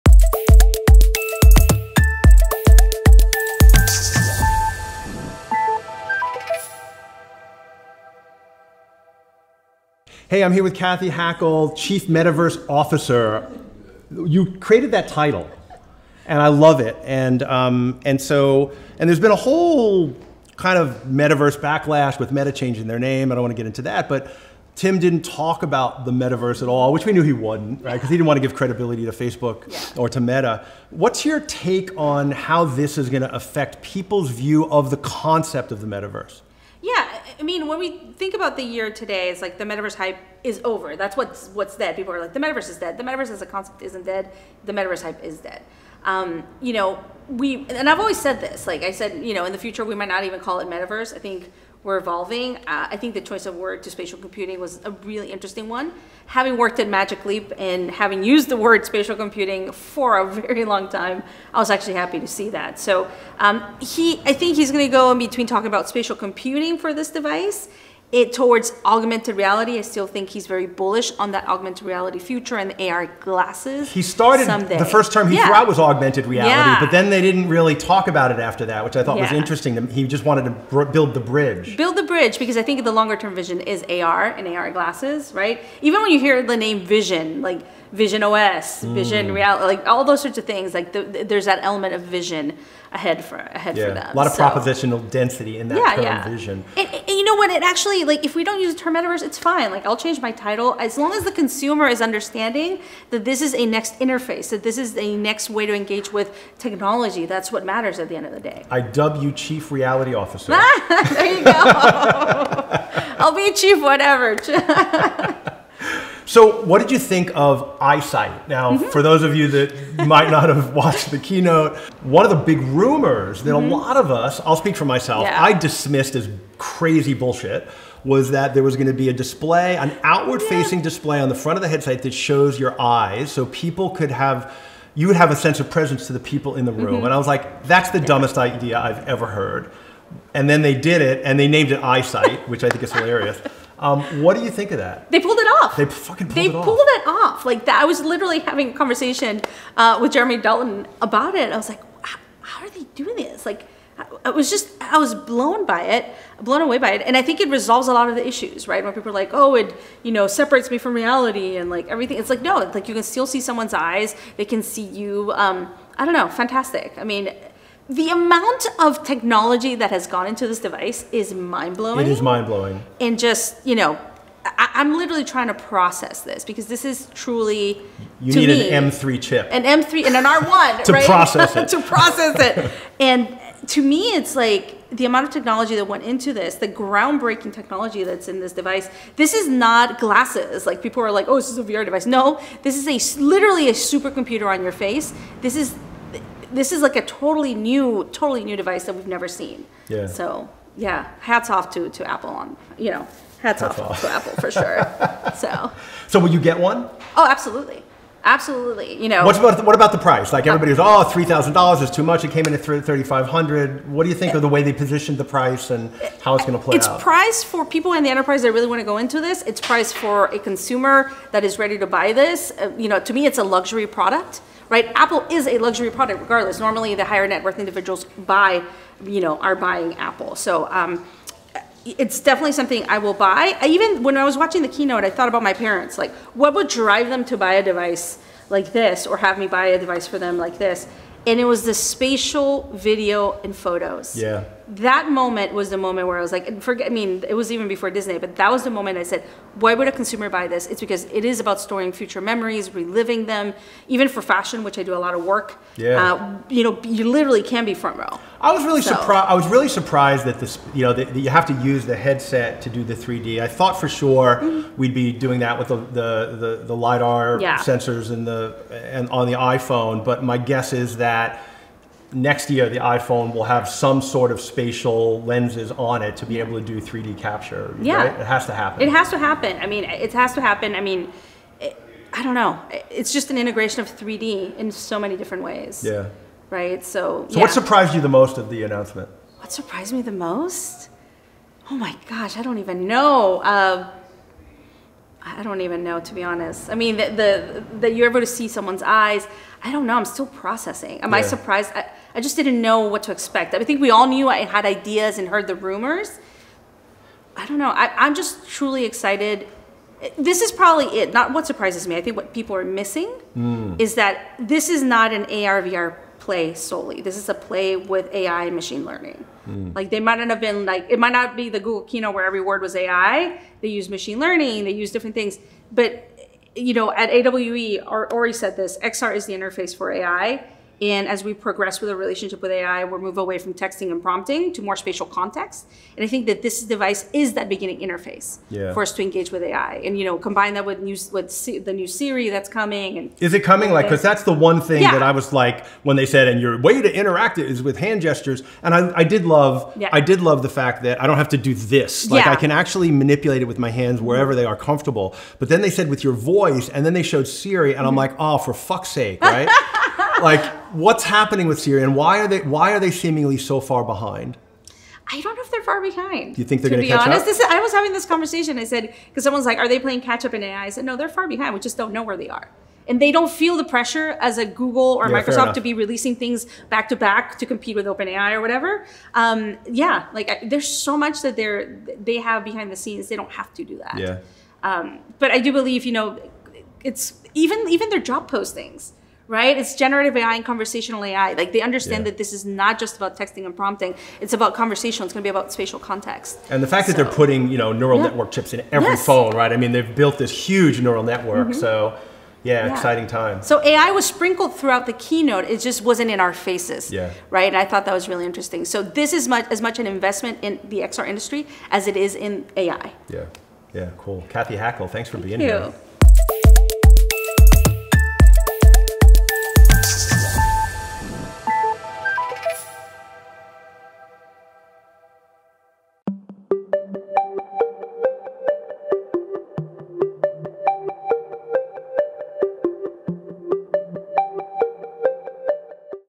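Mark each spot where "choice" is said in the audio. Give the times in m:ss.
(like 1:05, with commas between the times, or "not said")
0:53.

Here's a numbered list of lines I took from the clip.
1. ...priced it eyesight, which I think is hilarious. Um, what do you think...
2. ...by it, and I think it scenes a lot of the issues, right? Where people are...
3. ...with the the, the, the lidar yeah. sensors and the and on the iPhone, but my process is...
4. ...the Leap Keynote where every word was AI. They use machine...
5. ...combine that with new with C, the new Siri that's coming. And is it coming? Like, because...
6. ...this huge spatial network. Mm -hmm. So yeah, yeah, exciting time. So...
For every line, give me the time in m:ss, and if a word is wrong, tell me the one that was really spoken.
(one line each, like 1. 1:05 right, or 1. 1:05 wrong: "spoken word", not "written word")
1. 2:21 wrong: "named", not "priced"
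2. 2:36 wrong: "resolves", not "scenes"
3. 4:25 wrong: "guess", not "process"
4. 5:21 wrong: "Google", not "Leap"
5. 5:40 right
6. 6:40 wrong: "neural", not "spatial".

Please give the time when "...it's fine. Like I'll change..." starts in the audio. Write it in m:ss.
1:39.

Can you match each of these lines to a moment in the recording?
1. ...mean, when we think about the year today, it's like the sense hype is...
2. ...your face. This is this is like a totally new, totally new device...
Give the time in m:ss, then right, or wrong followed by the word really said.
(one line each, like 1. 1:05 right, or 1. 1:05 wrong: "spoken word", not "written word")
1. 0:37 wrong: "metaverse", not "sense"
2. 3:14 right.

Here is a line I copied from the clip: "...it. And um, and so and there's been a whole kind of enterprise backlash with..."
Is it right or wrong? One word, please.
wrong.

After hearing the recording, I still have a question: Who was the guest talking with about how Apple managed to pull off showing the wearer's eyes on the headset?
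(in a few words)
Jeremy Dalton.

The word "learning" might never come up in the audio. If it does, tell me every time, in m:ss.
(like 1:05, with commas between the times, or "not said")
5:18, 5:24.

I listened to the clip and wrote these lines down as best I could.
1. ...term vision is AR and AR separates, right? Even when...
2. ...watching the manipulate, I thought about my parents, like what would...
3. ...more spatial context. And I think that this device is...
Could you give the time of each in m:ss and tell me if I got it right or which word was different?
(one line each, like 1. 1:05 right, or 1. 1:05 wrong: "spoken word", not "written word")
1. 1:23 wrong: "glasses", not "separates"
2. 3:54 wrong: "keynote", not "manipulate"
3. 5:34 right.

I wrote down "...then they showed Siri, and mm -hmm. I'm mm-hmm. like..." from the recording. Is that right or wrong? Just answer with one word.
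right.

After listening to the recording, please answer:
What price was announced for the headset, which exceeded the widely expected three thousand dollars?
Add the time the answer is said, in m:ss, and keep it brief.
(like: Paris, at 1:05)
$3,500, at 3:32.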